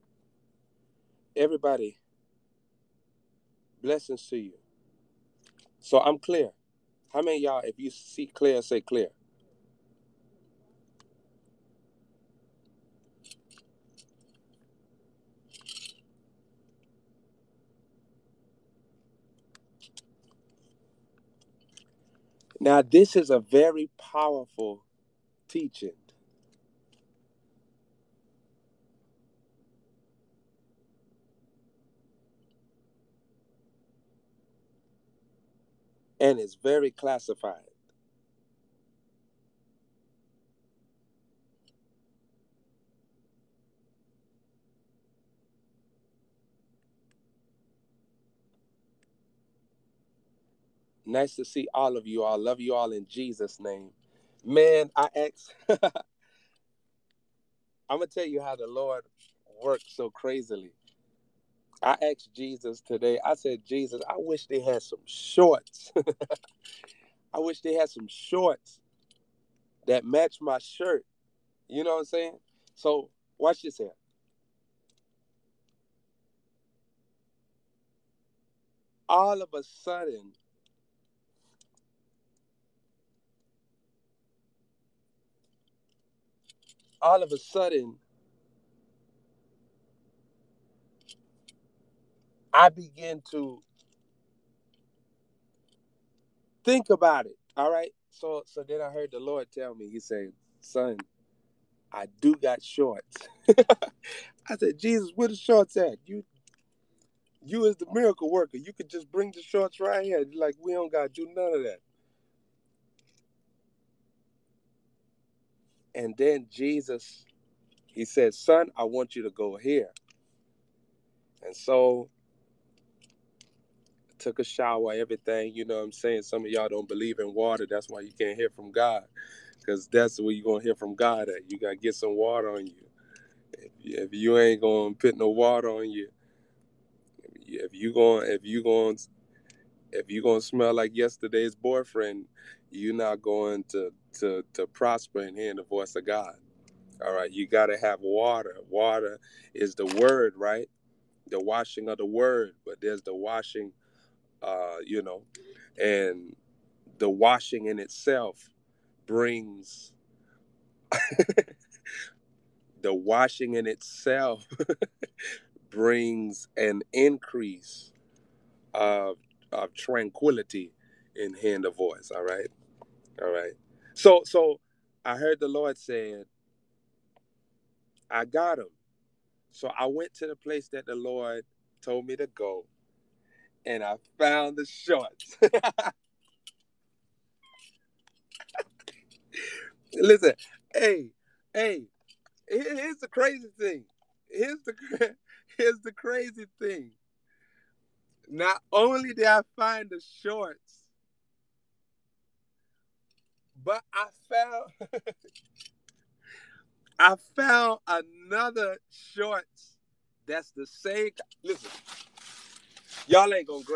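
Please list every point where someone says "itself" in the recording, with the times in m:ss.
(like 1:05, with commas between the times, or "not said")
2:37, 2:43.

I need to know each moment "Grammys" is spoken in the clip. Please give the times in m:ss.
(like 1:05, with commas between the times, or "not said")
not said.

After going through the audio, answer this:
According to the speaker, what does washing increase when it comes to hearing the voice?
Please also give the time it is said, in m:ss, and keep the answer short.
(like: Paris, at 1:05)
tranquility, at 2:49.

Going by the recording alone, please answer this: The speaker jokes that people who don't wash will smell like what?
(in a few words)
yesterday's boyfriend.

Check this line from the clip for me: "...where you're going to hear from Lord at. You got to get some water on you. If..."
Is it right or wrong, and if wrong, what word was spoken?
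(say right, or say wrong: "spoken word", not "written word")
wrong: "God", not "Lord".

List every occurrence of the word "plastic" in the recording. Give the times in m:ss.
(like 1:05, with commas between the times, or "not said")
not said.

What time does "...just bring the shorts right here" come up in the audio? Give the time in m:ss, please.
1:48.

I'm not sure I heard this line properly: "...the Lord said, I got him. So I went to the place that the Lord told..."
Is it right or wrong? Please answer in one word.
right.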